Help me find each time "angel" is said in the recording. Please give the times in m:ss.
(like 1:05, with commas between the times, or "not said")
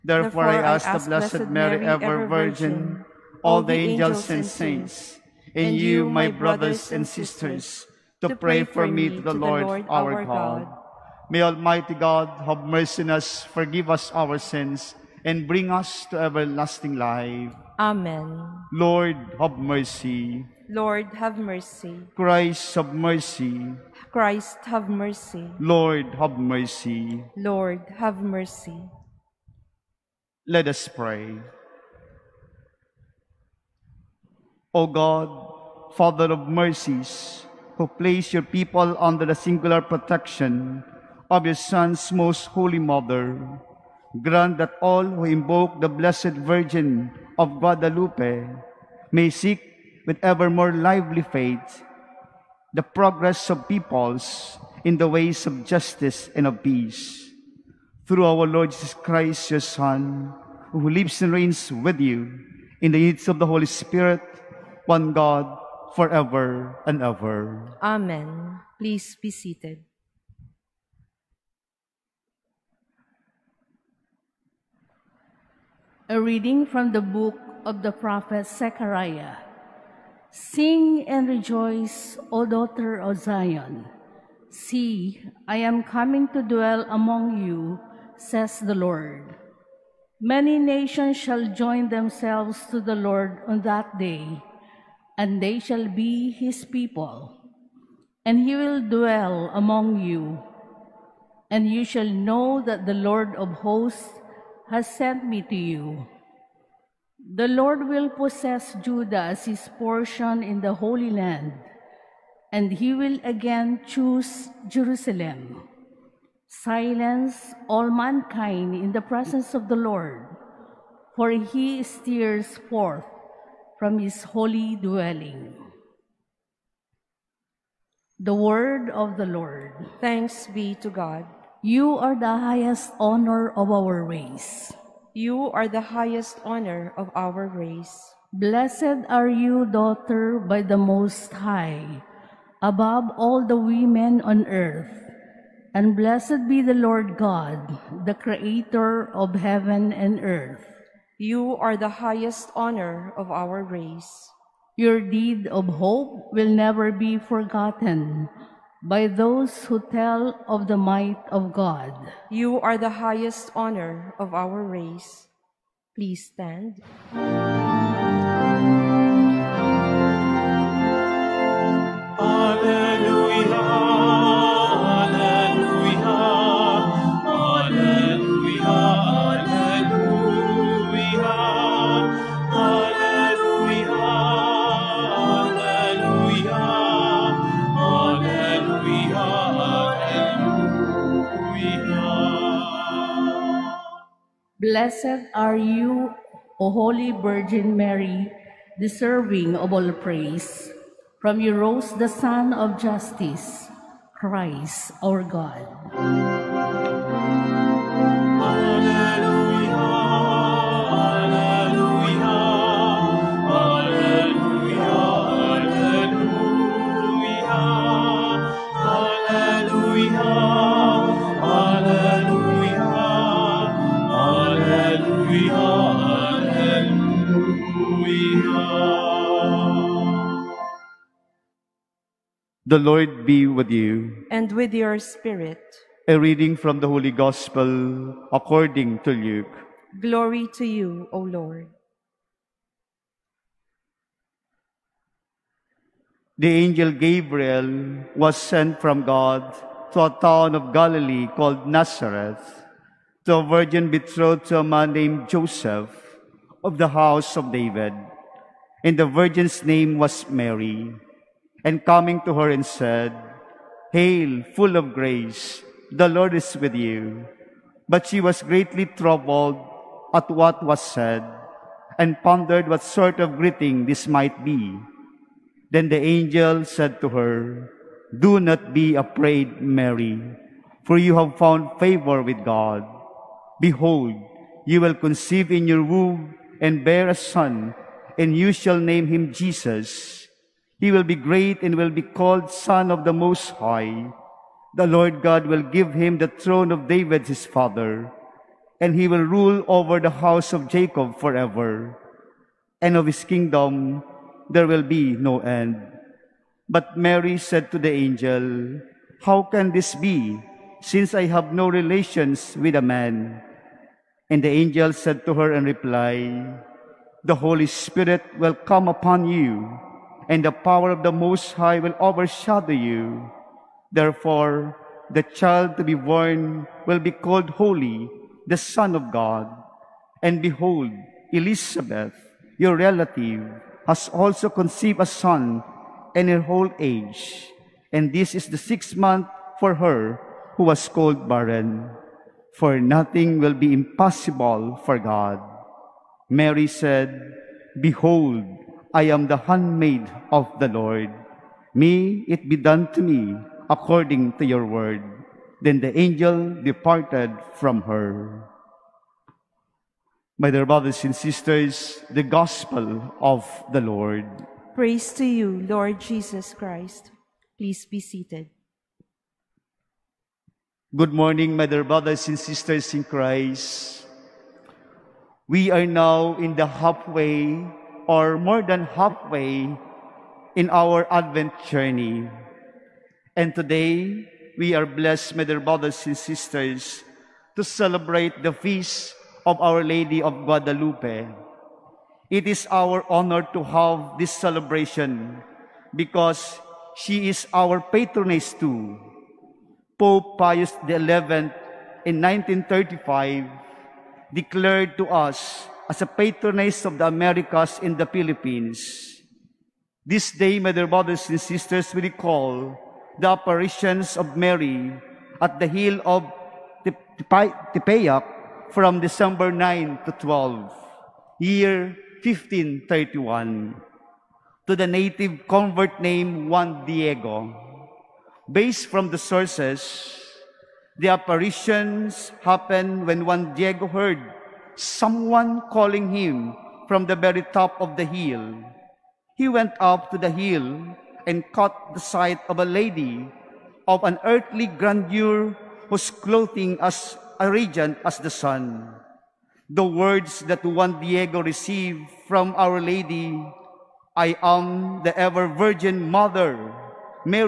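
0:03, 4:06, 4:36, 5:07, 5:14, 5:55.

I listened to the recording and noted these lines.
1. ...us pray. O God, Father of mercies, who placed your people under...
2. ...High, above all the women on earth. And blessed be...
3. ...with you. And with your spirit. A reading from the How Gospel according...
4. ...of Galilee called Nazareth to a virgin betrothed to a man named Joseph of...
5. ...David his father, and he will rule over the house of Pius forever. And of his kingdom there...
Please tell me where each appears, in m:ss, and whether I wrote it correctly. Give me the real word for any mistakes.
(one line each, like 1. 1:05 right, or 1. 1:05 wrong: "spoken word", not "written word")
1. 0:30 right
2. 2:21 right
3. 3:53 wrong: "Holy", not "How"
4. 4:10 right
5. 4:56 wrong: "Jacob", not "Pius".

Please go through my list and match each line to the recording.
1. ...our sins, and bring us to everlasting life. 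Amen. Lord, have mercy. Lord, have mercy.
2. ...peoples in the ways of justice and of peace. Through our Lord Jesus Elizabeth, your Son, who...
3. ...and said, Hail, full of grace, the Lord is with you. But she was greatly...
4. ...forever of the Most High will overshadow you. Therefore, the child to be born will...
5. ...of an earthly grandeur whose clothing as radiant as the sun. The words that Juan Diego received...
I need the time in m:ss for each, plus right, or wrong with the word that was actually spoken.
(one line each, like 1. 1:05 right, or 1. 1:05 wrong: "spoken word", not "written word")
1. 0:14 right
2. 0:53 wrong: "Christ", not "Elizabeth"
3. 4:22 right
4. 5:20 wrong: "power", not "forever"
5. 7:23 right.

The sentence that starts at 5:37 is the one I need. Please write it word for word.
And this is the sixth month for her who was called barren.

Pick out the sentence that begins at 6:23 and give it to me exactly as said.
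And today, we are blessed, my dear brothers and sisters, to celebrate the feast of Our Lady of Guadalupe.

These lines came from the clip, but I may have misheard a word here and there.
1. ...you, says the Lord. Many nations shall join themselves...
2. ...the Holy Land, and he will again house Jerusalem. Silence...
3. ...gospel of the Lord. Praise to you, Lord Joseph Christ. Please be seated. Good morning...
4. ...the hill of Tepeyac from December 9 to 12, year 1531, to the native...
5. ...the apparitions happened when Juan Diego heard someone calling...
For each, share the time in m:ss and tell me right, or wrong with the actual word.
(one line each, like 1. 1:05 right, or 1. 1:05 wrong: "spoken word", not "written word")
1. 1:27 right
2. 1:50 wrong: "choose", not "house"
3. 6:02 wrong: "Jesus", not "Joseph"
4. 6:55 right
5. 7:10 right.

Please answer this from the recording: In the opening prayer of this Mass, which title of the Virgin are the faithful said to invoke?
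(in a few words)
Blessed Virgin of Guadalupe.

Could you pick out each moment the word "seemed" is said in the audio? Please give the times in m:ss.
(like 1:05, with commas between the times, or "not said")
not said.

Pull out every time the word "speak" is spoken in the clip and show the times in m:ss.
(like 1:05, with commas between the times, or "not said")
not said.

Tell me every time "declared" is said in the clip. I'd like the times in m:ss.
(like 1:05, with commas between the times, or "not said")
6:44.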